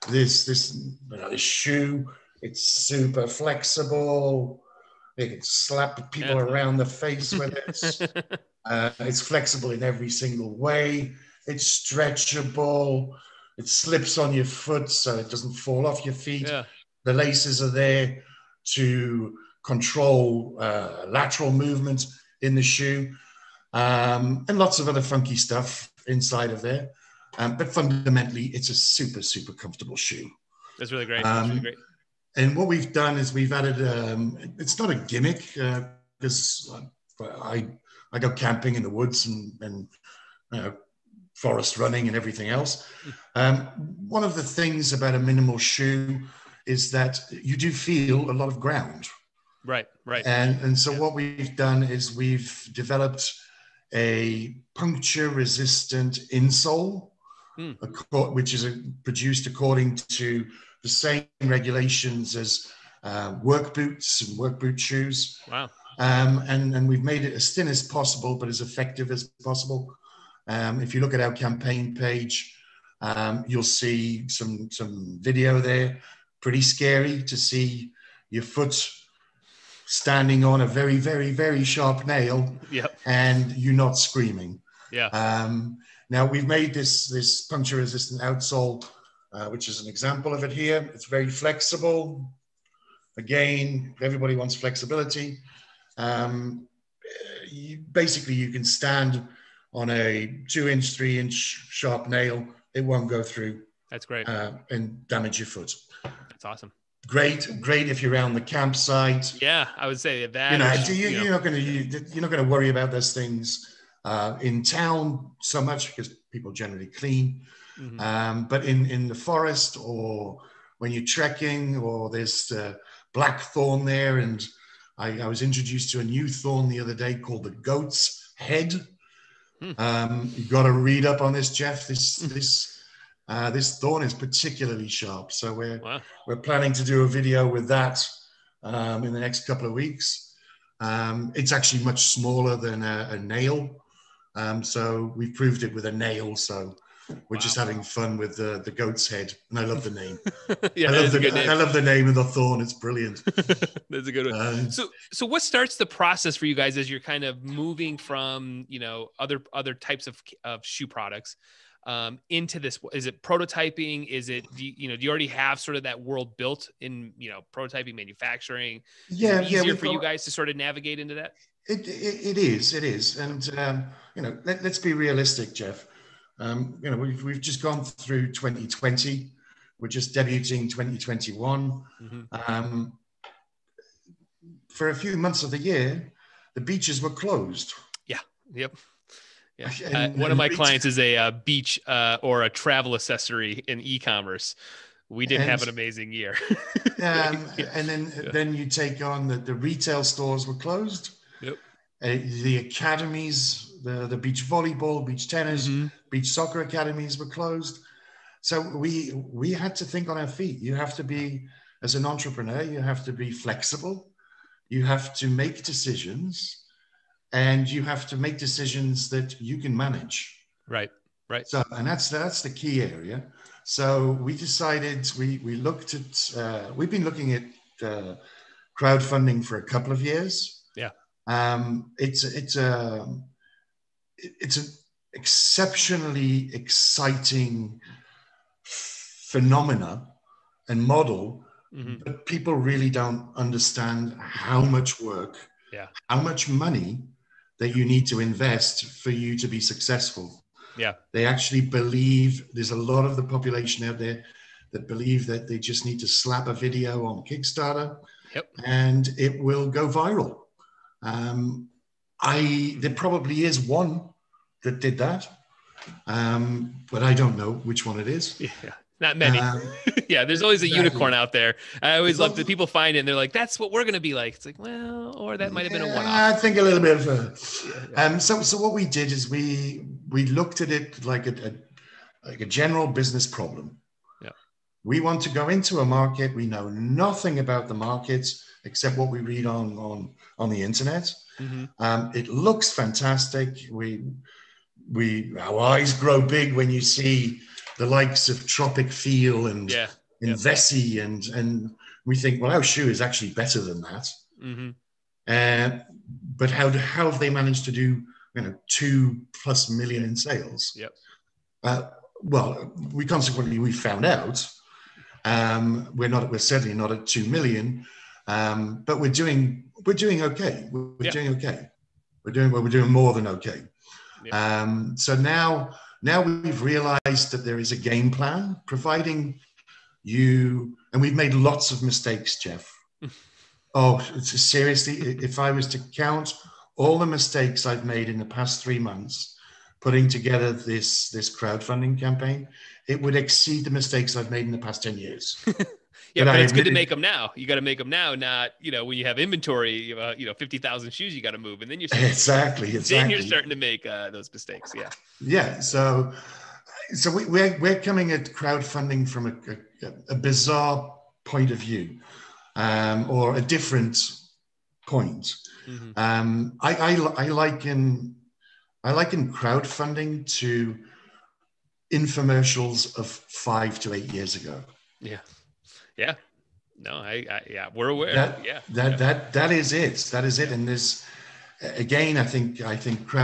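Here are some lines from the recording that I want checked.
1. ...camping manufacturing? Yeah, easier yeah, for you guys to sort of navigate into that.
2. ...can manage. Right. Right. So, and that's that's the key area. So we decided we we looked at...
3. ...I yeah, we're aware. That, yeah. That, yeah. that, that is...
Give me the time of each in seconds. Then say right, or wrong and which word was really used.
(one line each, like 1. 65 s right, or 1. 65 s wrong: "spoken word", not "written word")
1. 167 s wrong: "prototyping", not "camping"
2. 219 s right
3. 377 s right.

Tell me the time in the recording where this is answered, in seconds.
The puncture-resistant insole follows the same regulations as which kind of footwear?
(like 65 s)
63 s.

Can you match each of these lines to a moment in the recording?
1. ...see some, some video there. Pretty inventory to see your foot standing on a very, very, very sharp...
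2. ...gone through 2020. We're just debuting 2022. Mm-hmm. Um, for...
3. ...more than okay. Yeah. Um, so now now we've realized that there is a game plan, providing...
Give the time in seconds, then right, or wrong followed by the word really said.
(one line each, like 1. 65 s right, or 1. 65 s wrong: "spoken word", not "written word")
1. 73 s wrong: "scary", not "inventory"
2. 177 s wrong: "2021", not "2022"
3. 322 s right.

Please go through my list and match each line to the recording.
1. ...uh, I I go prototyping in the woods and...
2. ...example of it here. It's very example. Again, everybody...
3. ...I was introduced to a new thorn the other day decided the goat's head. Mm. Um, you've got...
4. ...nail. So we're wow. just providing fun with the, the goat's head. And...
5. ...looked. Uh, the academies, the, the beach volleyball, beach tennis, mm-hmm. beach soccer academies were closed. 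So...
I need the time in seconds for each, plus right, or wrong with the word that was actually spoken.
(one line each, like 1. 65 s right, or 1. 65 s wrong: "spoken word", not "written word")
1. 37 s wrong: "camping", not "prototyping"
2. 89 s wrong: "flexible", not "example"
3. 125 s wrong: "called", not "decided"
4. 145 s wrong: "having", not "providing"
5. 200 s wrong: "closed", not "looked".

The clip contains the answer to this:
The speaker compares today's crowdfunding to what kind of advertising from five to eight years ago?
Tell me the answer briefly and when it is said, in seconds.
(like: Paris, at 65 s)
Infomercials, at 371 s.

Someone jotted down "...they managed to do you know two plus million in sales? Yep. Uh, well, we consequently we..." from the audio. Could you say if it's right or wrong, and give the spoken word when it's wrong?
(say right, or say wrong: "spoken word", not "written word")
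right.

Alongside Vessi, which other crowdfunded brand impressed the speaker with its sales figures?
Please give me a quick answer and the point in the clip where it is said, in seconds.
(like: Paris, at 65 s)
Tropicfeel, at 298 s.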